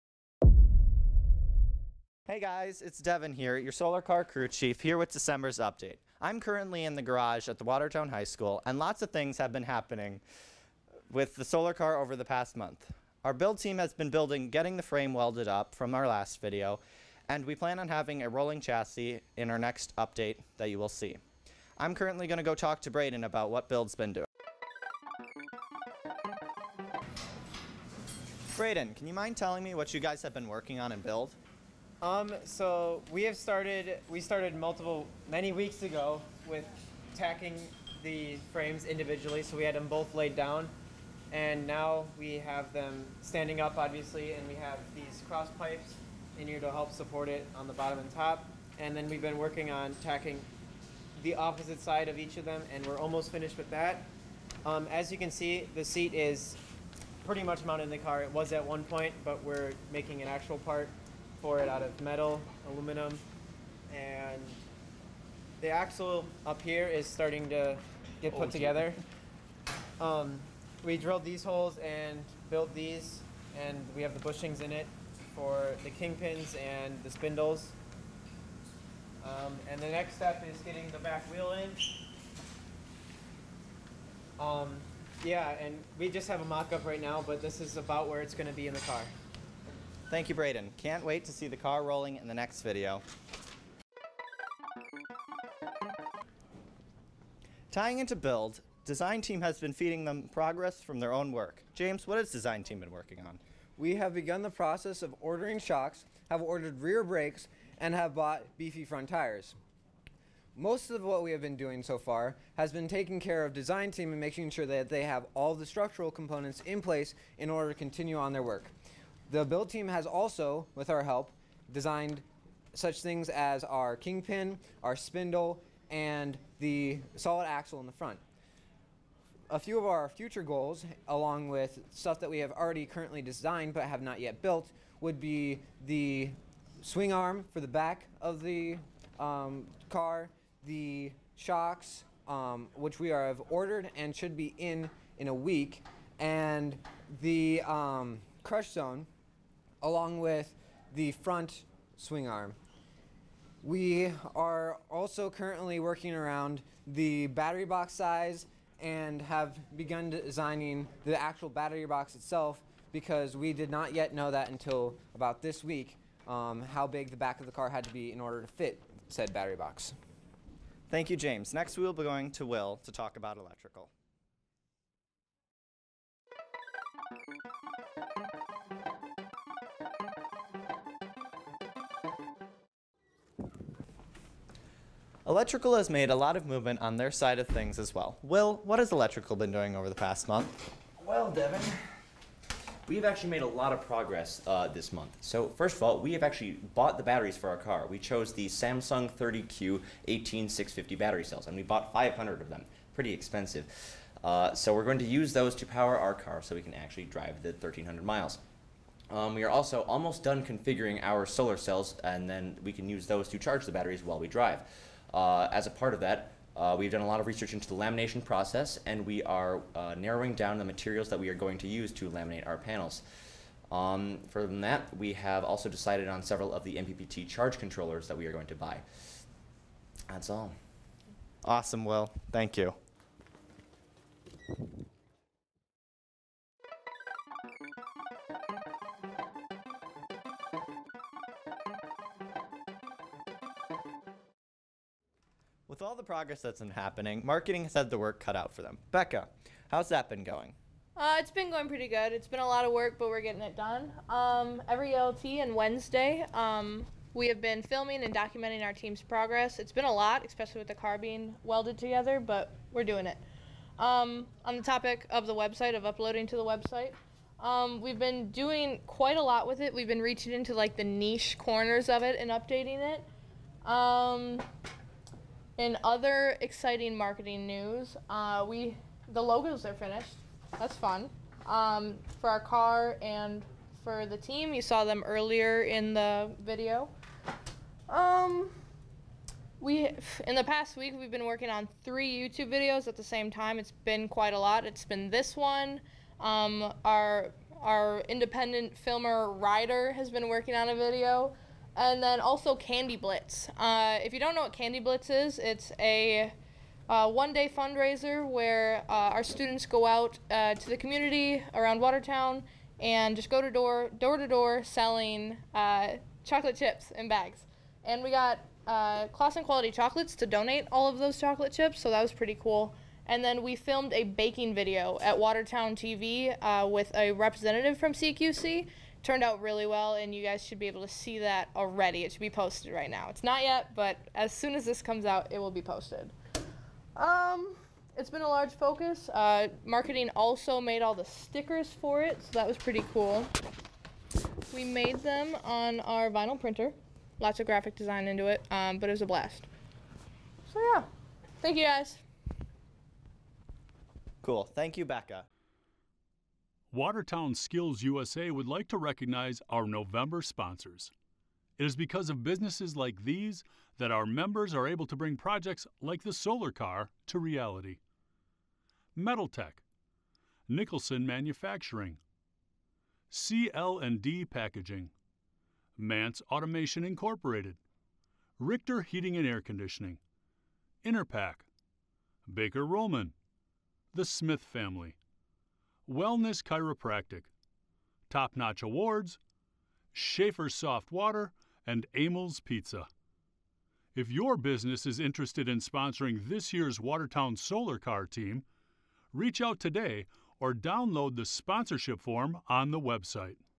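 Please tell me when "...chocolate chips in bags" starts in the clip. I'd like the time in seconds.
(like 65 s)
316 s.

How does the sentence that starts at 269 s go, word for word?
We've been reaching into like the niche corners of it and updating it.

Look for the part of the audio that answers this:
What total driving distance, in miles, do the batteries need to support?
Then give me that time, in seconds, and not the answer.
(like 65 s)
207 s.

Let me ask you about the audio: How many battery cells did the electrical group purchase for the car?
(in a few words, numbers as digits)
500.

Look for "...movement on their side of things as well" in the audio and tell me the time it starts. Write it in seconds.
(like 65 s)
186 s.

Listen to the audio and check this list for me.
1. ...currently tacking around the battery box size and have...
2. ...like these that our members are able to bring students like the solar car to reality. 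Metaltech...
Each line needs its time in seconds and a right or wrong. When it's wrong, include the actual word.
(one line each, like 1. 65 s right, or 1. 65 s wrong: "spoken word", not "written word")
1. 155 s wrong: "working", not "tacking"
2. 362 s wrong: "projects", not "students".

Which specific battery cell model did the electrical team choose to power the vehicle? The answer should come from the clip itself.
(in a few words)
Samsung 30Q 18650.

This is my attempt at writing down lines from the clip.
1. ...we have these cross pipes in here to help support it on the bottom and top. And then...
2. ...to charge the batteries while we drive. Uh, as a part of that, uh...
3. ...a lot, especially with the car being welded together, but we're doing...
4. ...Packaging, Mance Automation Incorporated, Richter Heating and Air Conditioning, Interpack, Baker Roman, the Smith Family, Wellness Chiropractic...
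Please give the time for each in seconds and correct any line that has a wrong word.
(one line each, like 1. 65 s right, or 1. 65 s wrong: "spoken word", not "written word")
1. 44 s right
2. 213 s right
3. 259 s right
4. 374 s right.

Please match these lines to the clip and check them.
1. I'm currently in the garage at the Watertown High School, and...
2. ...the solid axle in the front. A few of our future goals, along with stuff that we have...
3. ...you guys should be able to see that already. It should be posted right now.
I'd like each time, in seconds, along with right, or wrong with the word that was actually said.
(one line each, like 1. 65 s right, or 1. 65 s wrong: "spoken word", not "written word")
1. 6 s right
2. 126 s right
3. 330 s right.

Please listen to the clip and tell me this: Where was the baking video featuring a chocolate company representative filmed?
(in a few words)
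Watertown TV.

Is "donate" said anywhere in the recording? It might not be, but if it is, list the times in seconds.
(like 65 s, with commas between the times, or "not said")
320 s.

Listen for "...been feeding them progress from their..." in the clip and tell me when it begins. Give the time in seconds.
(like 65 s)
99 s.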